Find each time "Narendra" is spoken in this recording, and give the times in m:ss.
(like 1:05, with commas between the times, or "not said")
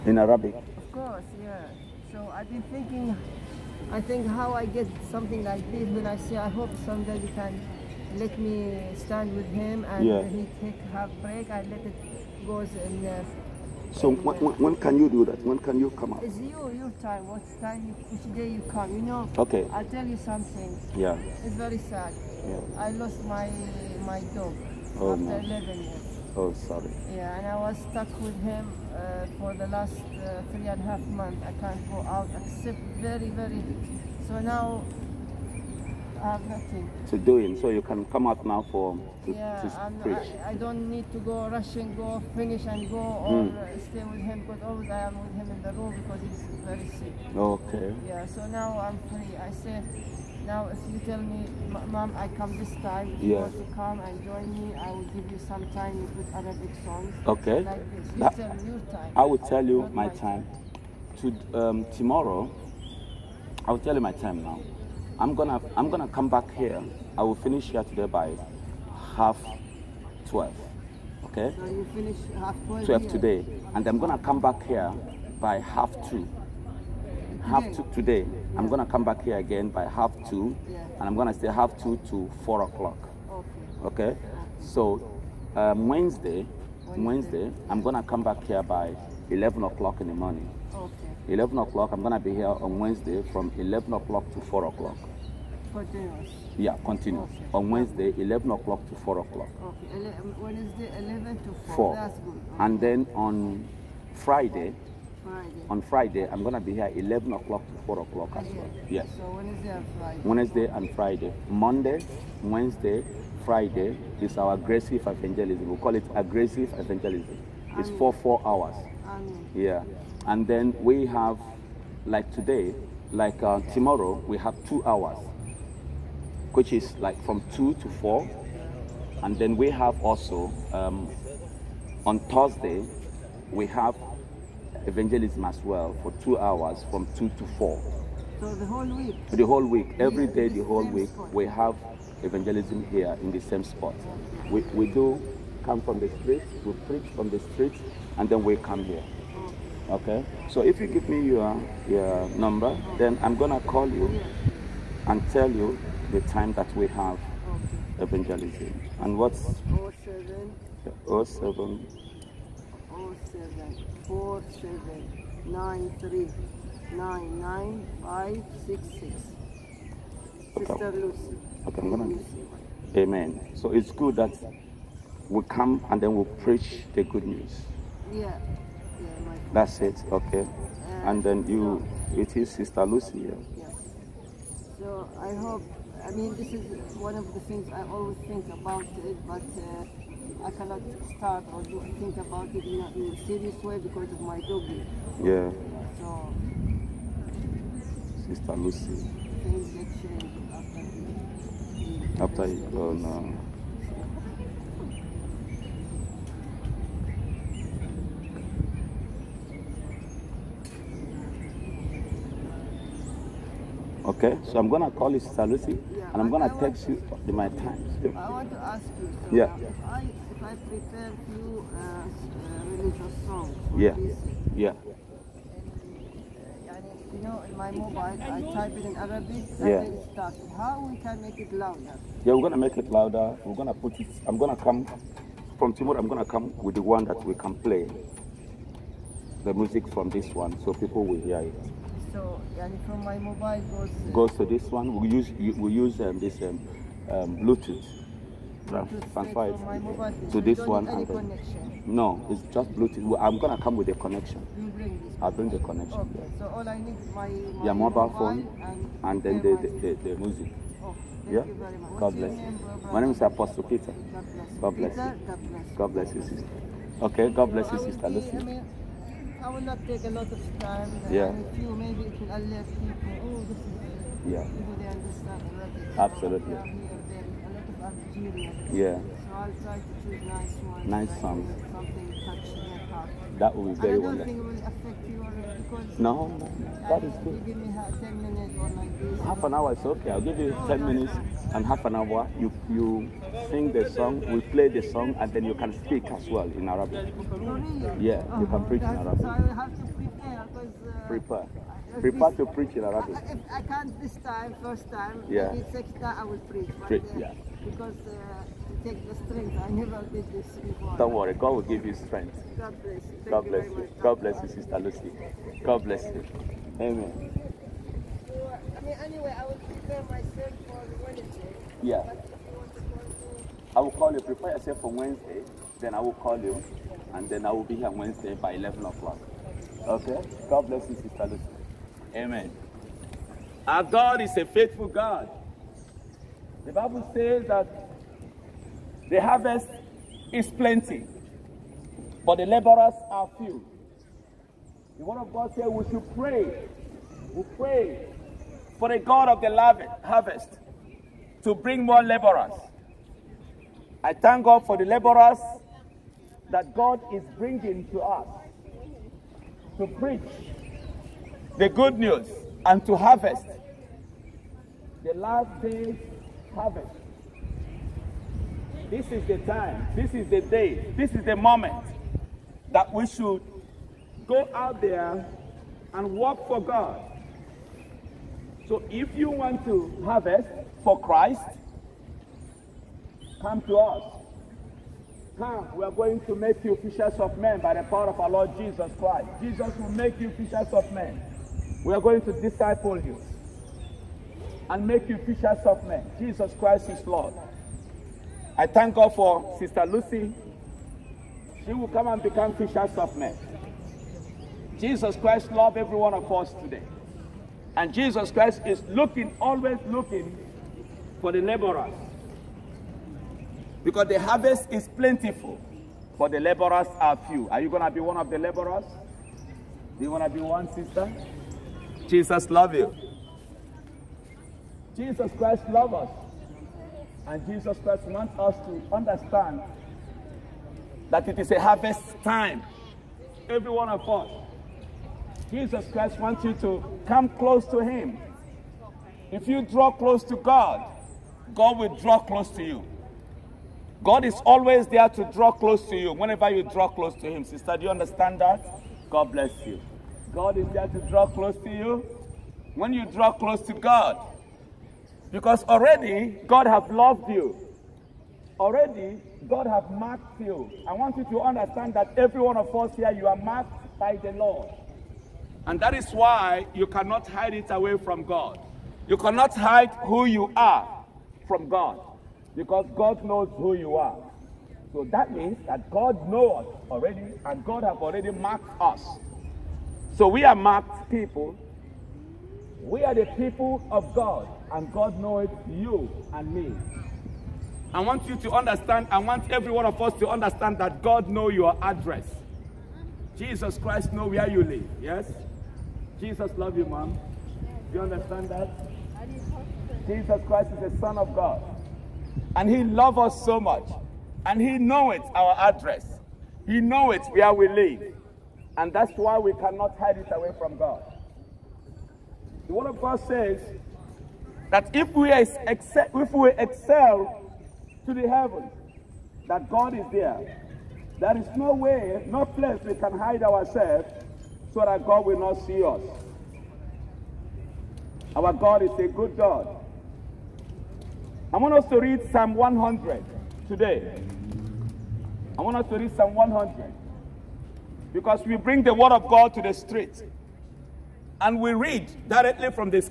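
not said.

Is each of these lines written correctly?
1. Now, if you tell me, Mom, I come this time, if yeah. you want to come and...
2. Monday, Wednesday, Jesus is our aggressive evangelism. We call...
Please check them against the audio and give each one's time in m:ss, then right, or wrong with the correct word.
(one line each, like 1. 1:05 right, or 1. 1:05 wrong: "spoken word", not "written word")
1. 0:50 right
2. 1:51 wrong: "Friday", not "Jesus".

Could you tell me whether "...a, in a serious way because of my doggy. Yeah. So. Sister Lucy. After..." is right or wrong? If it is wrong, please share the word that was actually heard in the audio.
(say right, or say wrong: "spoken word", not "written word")
right.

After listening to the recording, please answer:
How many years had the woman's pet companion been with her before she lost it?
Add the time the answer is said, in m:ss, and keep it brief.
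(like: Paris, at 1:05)
11, at 0:25.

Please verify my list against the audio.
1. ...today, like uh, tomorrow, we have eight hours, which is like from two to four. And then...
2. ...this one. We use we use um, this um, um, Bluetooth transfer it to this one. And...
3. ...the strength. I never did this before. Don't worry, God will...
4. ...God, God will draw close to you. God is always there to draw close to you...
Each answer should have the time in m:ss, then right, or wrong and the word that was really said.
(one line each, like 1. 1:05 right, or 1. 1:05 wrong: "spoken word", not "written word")
1. 2:02 wrong: "two", not "eight"
2. 4:04 right
3. 5:08 right
4. 7:20 right.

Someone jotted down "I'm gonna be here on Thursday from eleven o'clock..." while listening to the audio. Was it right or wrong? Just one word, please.
wrong.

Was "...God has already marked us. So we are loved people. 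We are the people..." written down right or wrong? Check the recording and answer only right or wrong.
wrong.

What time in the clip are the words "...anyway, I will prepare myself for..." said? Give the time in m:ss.
5:19.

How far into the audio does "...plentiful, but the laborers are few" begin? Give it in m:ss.
6:54.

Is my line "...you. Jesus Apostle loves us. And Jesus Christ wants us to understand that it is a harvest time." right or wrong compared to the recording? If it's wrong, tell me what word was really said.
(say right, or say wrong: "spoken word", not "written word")
wrong: "Christ", not "Apostle".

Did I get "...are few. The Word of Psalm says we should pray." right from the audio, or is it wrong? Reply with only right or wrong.
wrong.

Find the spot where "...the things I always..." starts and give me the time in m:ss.
3:07.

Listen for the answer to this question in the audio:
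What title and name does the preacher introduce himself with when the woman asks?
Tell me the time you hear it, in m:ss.
4:23.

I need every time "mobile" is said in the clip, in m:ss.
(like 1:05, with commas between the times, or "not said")
3:47, 4:03, 4:17.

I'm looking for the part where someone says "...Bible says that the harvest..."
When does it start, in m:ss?
5:36.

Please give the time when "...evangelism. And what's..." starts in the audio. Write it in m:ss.
2:37.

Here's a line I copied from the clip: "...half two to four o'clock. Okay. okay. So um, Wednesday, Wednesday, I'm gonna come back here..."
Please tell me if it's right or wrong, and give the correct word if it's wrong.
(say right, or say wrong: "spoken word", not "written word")
right.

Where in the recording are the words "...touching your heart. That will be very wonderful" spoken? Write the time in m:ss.
4:42.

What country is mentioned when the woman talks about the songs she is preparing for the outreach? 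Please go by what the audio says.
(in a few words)
Algeria.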